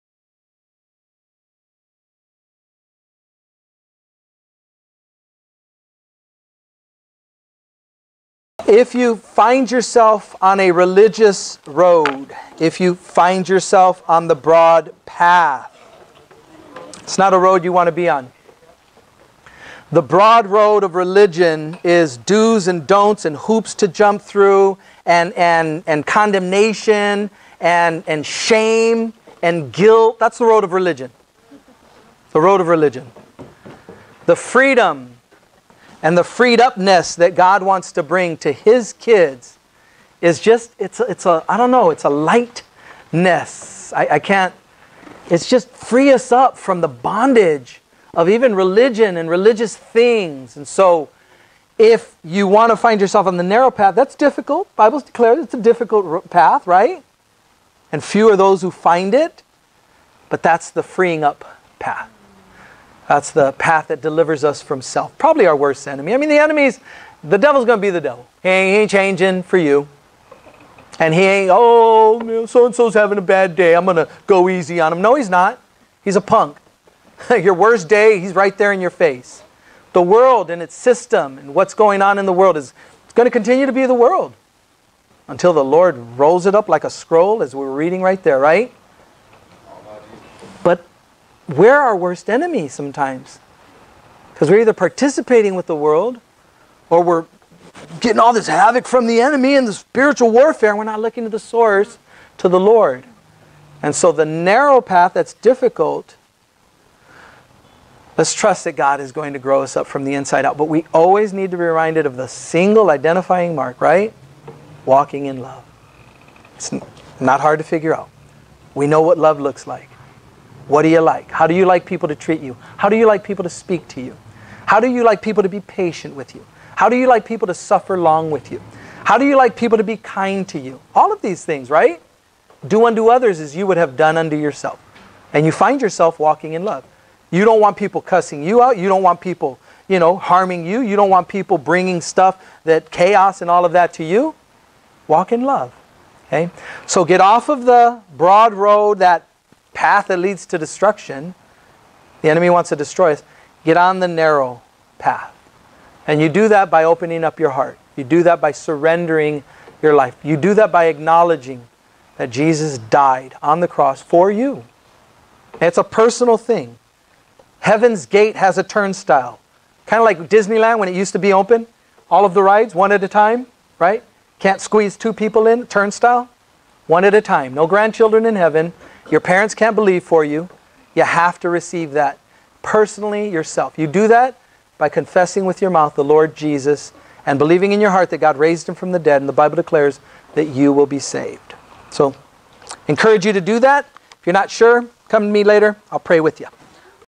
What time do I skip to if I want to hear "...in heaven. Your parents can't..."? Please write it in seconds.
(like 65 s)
178 s.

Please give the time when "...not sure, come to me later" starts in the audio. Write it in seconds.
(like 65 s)
194 s.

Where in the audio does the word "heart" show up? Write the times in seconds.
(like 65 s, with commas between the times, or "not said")
157 s, 187 s.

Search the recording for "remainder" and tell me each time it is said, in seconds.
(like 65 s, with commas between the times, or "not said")
not said.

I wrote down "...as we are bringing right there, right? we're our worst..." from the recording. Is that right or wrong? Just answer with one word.
wrong.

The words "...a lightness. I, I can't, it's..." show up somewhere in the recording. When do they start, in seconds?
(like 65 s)
42 s.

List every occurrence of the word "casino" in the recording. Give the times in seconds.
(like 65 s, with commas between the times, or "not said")
not said.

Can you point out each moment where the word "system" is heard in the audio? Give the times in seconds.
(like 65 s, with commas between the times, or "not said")
80 s.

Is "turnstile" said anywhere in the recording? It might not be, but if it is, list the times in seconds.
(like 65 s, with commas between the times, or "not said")
168 s, 175 s.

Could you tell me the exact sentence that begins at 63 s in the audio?
That's the path that delivers us from self.